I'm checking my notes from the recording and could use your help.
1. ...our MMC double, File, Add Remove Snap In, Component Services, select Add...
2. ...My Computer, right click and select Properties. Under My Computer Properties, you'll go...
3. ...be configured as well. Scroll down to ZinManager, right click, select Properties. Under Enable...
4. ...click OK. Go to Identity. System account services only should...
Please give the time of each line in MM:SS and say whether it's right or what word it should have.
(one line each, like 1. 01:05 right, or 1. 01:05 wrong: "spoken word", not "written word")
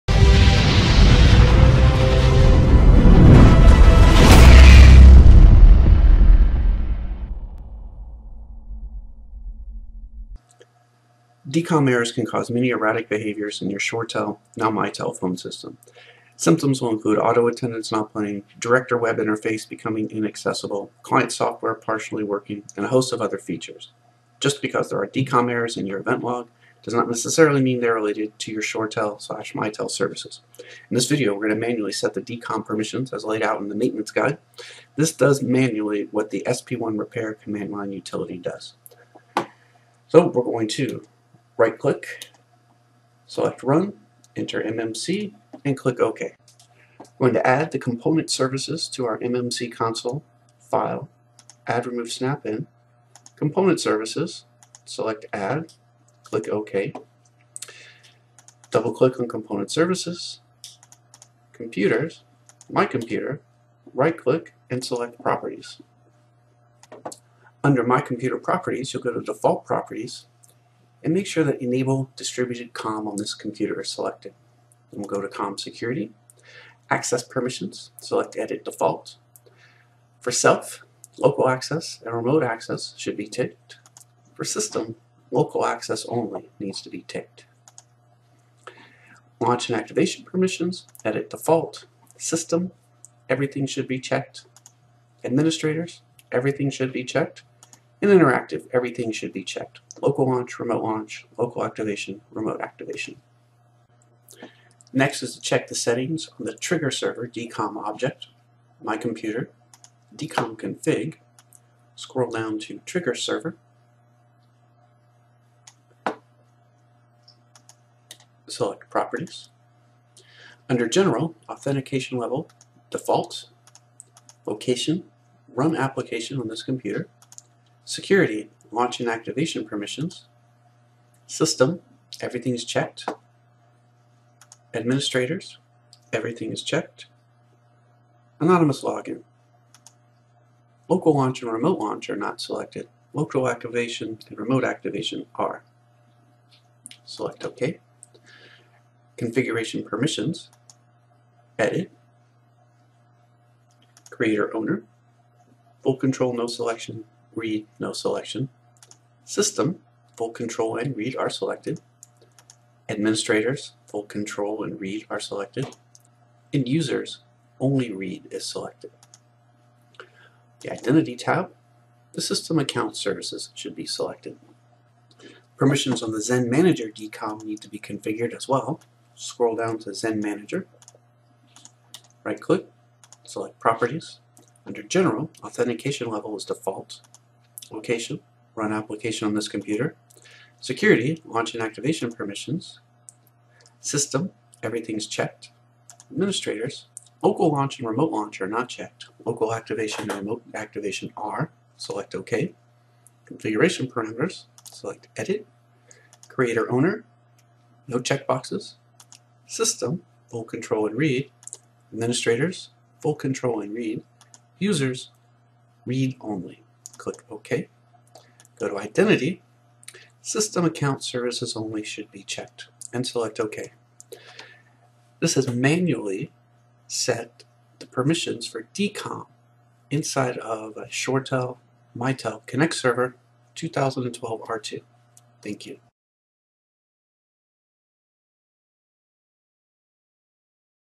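1. 00:49 wrong: "console", not "double"
2. 01:02 right
3. 02:57 wrong: "General", not "Enable"
4. 03:37 right.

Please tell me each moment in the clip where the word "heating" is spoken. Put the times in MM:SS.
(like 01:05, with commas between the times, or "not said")
not said.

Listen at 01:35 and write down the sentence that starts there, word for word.
Administrators, everything should be checked and interactive, everything should be checked.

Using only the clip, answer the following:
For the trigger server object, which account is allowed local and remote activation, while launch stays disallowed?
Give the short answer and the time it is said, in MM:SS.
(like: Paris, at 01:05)
Anonymous login, at 02:18.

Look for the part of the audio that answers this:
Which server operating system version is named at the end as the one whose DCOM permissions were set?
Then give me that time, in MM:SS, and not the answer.
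03:53.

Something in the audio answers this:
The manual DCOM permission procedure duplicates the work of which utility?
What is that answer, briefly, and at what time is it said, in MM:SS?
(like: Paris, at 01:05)
SP1 repair command line utility, at 00:36.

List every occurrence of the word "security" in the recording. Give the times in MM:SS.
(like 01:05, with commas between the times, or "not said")
01:15, 02:07, 03:10.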